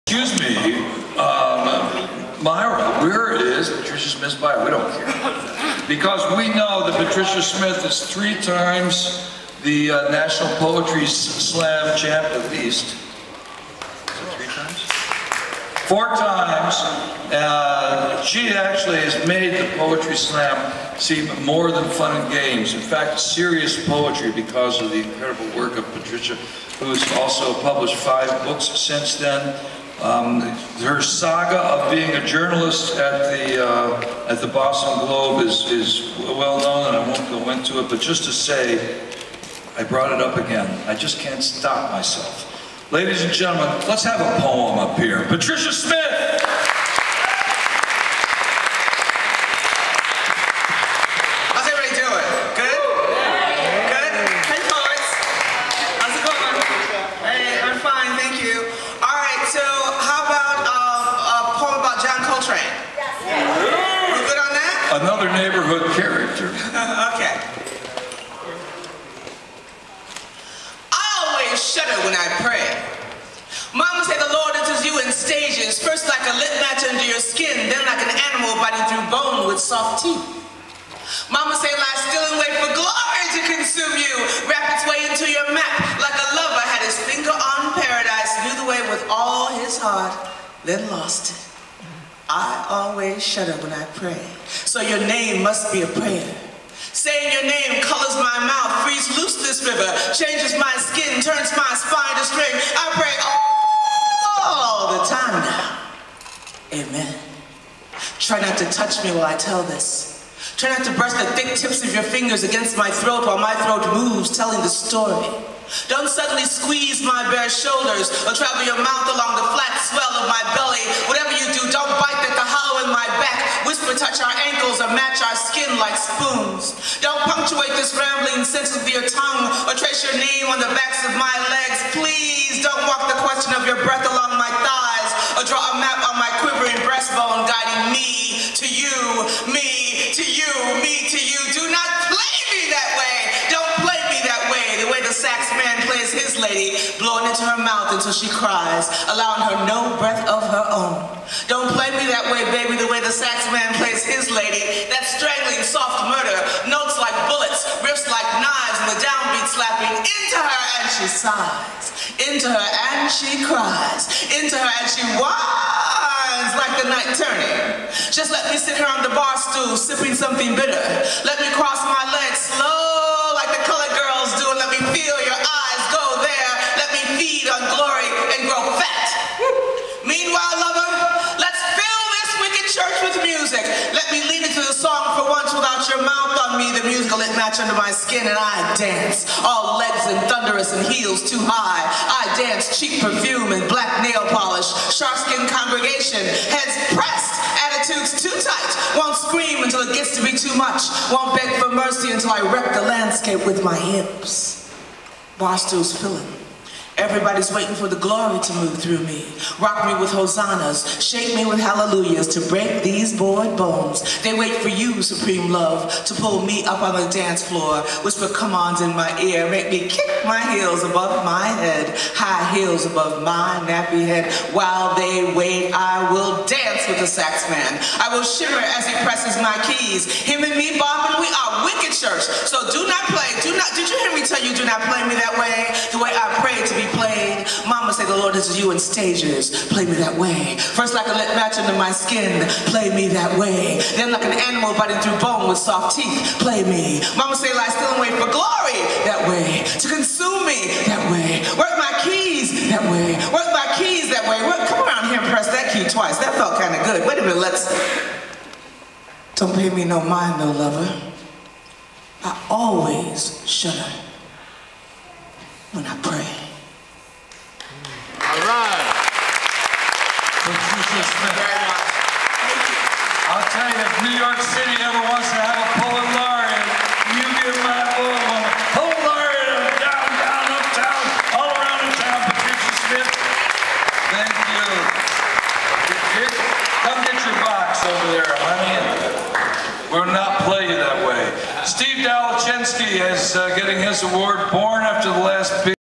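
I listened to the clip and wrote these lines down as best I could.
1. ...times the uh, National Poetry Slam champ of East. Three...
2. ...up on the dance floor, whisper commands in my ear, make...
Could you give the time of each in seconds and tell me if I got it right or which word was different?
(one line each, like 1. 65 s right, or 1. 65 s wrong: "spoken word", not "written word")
1. 8 s right
2. 216 s right.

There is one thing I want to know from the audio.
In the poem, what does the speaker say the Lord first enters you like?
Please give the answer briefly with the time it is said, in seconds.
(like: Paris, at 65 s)
A lit match under your skin, at 76 s.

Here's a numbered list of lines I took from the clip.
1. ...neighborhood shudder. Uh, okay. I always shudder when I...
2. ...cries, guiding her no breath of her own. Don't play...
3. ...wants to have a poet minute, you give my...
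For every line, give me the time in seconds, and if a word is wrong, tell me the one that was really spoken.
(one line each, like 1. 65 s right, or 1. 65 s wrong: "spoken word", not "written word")
1. 65 s wrong: "character", not "shudder"
2. 148 s wrong: "allowing", not "guiding"
3. 275 s wrong: "laureate", not "minute".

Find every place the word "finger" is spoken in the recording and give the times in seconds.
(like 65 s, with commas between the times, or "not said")
87 s, 112 s.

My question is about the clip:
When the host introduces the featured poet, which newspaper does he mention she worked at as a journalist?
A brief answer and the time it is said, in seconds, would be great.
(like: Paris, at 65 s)
Boston Globe, at 34 s.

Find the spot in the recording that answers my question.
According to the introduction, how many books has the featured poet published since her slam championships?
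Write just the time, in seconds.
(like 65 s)
27 s.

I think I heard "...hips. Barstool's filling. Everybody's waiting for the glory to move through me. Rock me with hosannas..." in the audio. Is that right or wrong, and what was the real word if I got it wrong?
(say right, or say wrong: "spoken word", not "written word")
right.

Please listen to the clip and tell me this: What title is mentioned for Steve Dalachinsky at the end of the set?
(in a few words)
Born After the Last Beat.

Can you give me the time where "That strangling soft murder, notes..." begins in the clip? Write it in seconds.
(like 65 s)
154 s.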